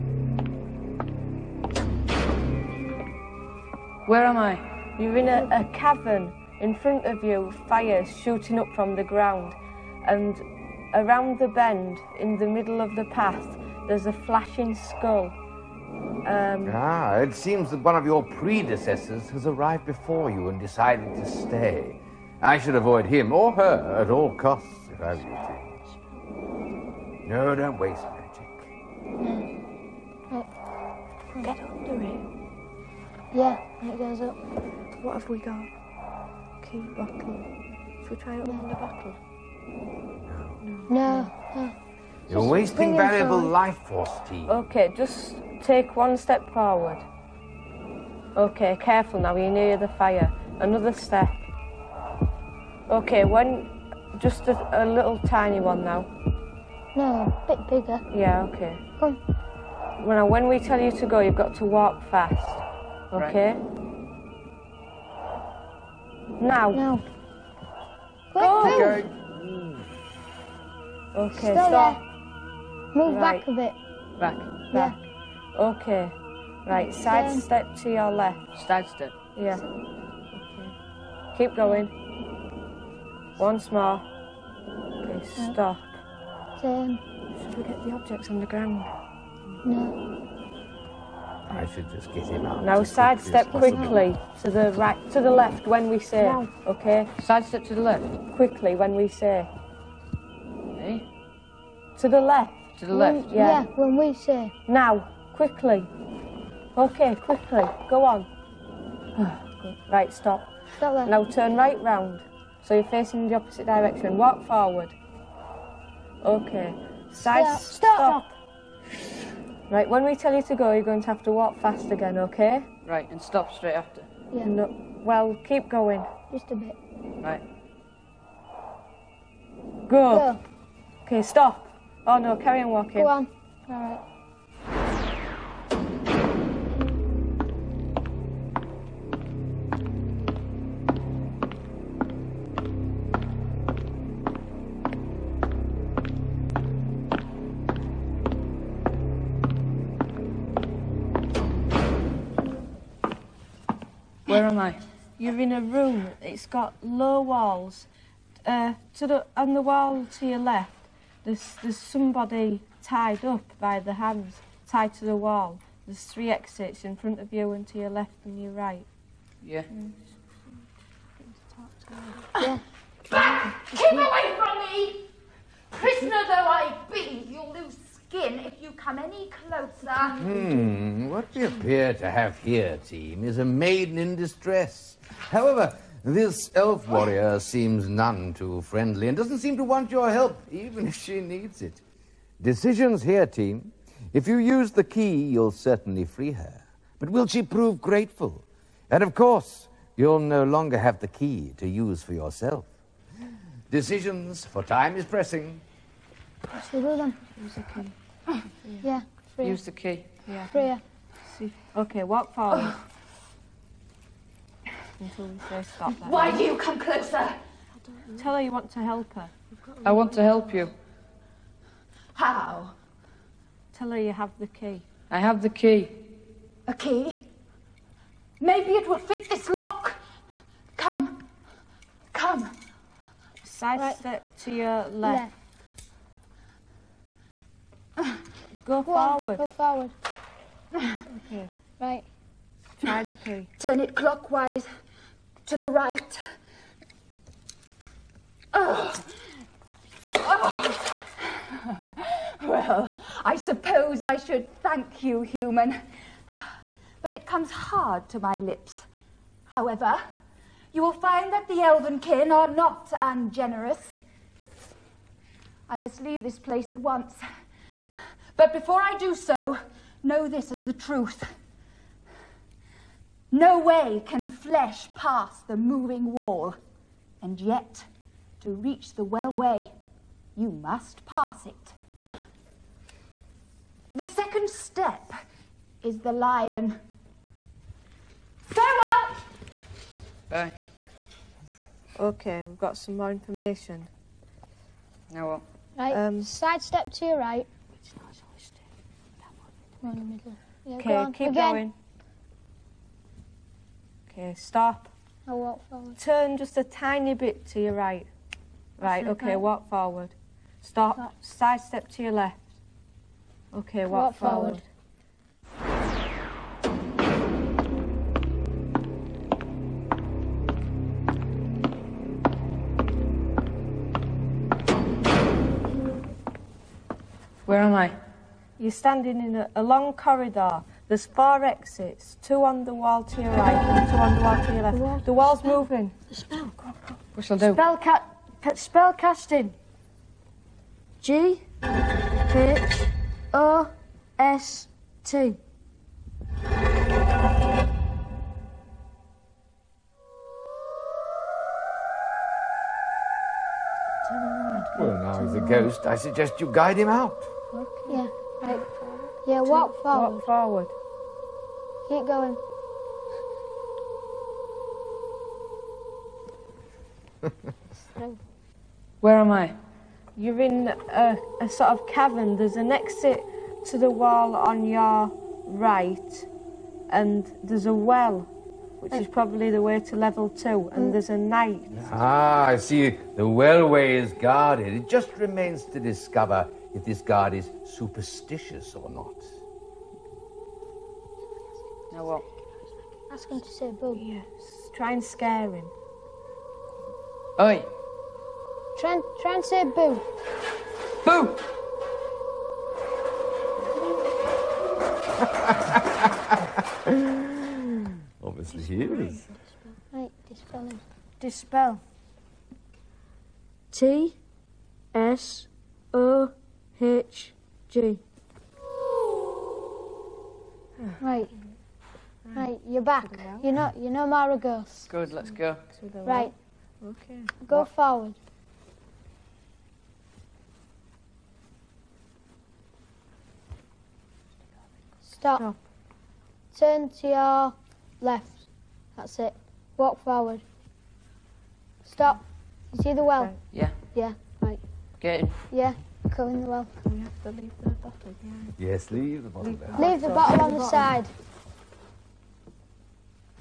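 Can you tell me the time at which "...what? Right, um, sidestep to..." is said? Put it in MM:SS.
04:55.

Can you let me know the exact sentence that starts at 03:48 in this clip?
Maybe it will fit this lock.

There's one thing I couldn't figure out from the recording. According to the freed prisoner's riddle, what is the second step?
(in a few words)
The lion.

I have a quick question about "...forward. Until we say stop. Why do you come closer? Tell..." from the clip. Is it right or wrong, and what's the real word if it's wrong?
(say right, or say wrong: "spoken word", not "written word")
right.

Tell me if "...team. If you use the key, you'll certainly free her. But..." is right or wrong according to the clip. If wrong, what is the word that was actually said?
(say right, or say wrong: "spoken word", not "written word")
right.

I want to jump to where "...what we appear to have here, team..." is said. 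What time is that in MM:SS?
03:01.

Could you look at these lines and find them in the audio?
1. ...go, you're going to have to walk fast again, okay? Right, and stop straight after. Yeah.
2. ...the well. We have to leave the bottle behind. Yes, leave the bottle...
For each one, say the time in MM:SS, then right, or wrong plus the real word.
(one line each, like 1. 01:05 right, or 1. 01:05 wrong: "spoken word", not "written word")
1. 02:00 right
2. 07:26 right.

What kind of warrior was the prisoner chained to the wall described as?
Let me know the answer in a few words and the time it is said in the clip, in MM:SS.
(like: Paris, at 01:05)
Elf warrior, at 03:06.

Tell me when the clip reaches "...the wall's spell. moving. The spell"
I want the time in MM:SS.
05:35.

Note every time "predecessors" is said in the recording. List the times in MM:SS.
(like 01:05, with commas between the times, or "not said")
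00:18.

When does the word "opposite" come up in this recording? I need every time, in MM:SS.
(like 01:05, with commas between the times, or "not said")
01:53.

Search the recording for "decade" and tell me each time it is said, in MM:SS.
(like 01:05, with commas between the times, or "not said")
not said.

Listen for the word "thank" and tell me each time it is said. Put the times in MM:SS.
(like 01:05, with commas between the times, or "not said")
04:14.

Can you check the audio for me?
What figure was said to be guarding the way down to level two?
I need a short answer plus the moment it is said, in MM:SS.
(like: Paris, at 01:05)
A knight, at 06:20.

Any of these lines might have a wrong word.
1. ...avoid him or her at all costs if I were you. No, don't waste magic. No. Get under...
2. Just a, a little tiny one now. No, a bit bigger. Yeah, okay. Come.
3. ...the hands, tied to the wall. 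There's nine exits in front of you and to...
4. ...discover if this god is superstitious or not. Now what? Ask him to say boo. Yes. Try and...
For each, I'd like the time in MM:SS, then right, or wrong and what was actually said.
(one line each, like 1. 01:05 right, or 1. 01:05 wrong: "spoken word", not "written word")
1. 00:22 right
2. 00:54 right
3. 02:43 wrong: "three", not "nine"
4. 06:25 right.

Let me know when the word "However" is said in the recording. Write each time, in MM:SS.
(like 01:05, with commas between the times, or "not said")
03:05, 04:19.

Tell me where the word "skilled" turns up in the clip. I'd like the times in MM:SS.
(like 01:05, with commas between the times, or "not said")
not said.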